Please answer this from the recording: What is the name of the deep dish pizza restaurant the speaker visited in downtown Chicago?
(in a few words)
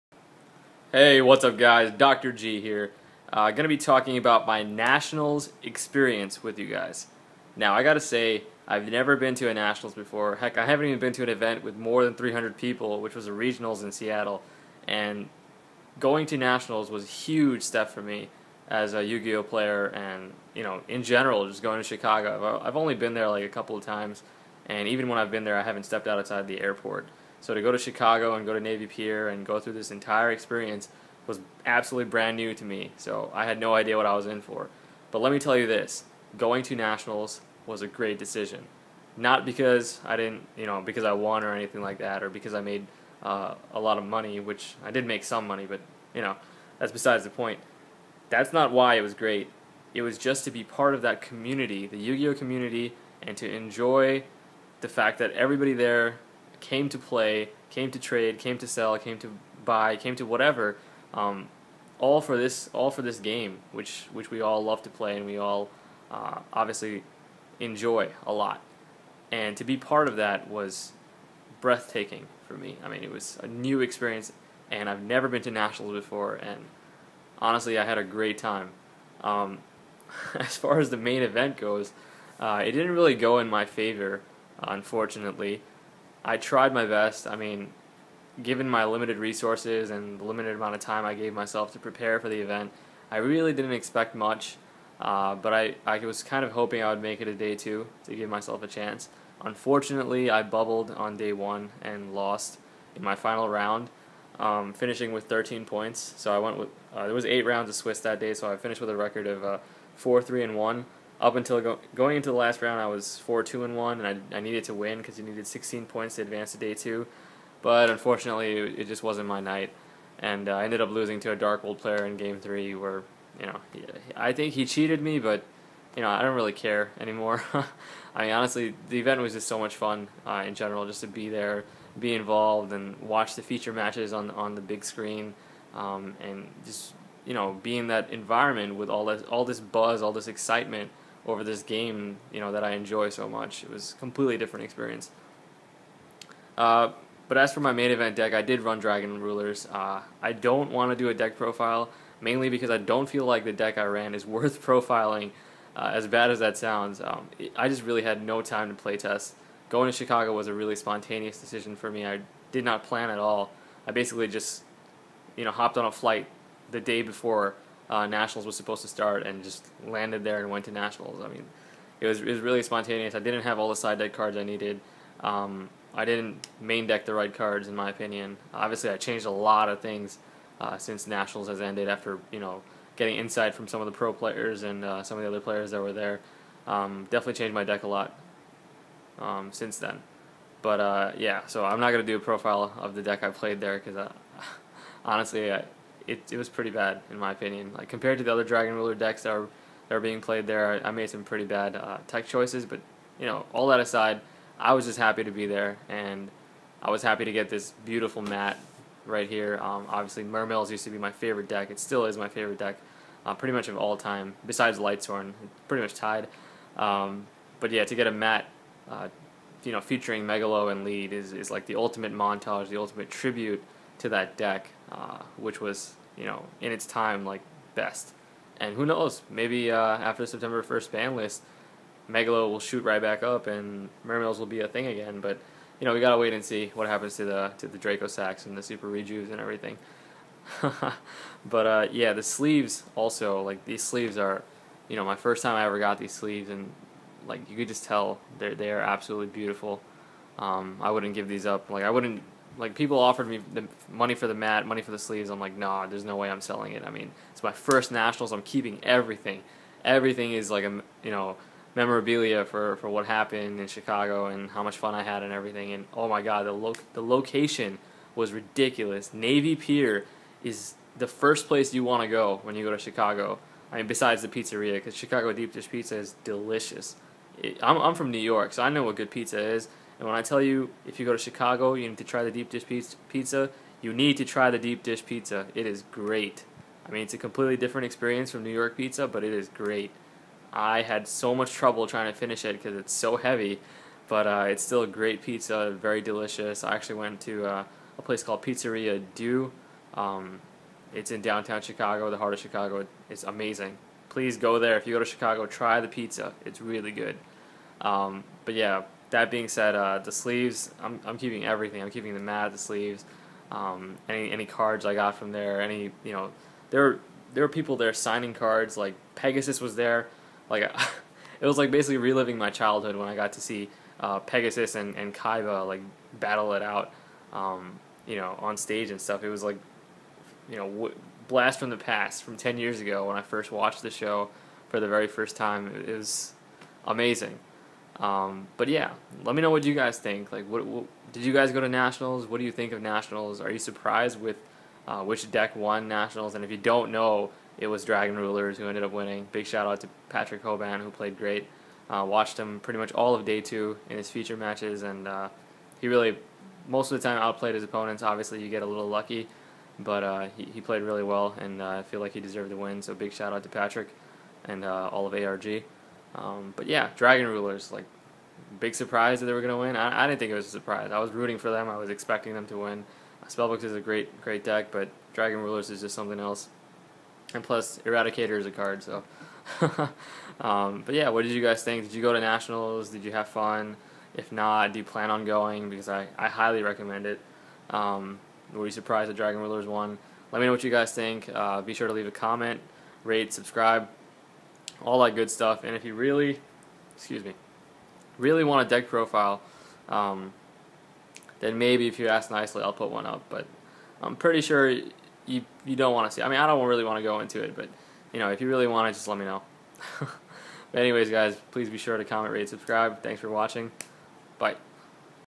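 Pizzeria Due.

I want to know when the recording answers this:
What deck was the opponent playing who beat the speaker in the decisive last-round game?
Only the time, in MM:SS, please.
02:01.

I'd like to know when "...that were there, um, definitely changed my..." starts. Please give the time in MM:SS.
03:05.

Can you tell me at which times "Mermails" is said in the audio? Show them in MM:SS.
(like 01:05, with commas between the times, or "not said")
03:30, 03:54.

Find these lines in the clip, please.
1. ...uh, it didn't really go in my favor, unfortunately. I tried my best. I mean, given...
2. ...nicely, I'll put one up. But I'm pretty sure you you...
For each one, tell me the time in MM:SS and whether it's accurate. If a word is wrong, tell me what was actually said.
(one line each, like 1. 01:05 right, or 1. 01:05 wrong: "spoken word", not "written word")
1. 01:22 right
2. 06:42 right.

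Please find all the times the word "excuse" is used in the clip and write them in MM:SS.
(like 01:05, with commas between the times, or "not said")
06:36.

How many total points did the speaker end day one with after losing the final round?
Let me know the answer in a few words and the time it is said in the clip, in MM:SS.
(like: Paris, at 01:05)
13, at 01:45.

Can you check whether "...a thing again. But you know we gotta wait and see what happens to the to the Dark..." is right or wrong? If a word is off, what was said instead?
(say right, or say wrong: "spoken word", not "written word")
wrong: "Dracossacks", not "Dark".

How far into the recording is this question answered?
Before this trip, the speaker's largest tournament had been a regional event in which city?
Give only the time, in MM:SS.
00:13.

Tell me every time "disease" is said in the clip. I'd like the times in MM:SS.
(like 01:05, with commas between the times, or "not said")
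not said.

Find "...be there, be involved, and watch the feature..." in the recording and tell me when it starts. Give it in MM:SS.
02:11.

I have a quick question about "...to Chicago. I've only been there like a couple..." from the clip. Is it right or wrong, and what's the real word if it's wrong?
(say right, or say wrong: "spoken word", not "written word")
right.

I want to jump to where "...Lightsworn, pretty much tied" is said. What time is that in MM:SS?
03:34.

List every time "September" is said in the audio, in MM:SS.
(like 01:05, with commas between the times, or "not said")
03:50.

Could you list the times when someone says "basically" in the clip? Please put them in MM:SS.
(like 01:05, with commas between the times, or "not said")
02:43, 05:21.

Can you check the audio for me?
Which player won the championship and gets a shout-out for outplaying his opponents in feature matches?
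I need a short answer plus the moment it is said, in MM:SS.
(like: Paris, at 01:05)
Patrick Hoban, at 05:50.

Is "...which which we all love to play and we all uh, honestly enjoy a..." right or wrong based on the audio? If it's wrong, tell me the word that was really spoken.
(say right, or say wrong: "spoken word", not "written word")
wrong: "obviously", not "honestly".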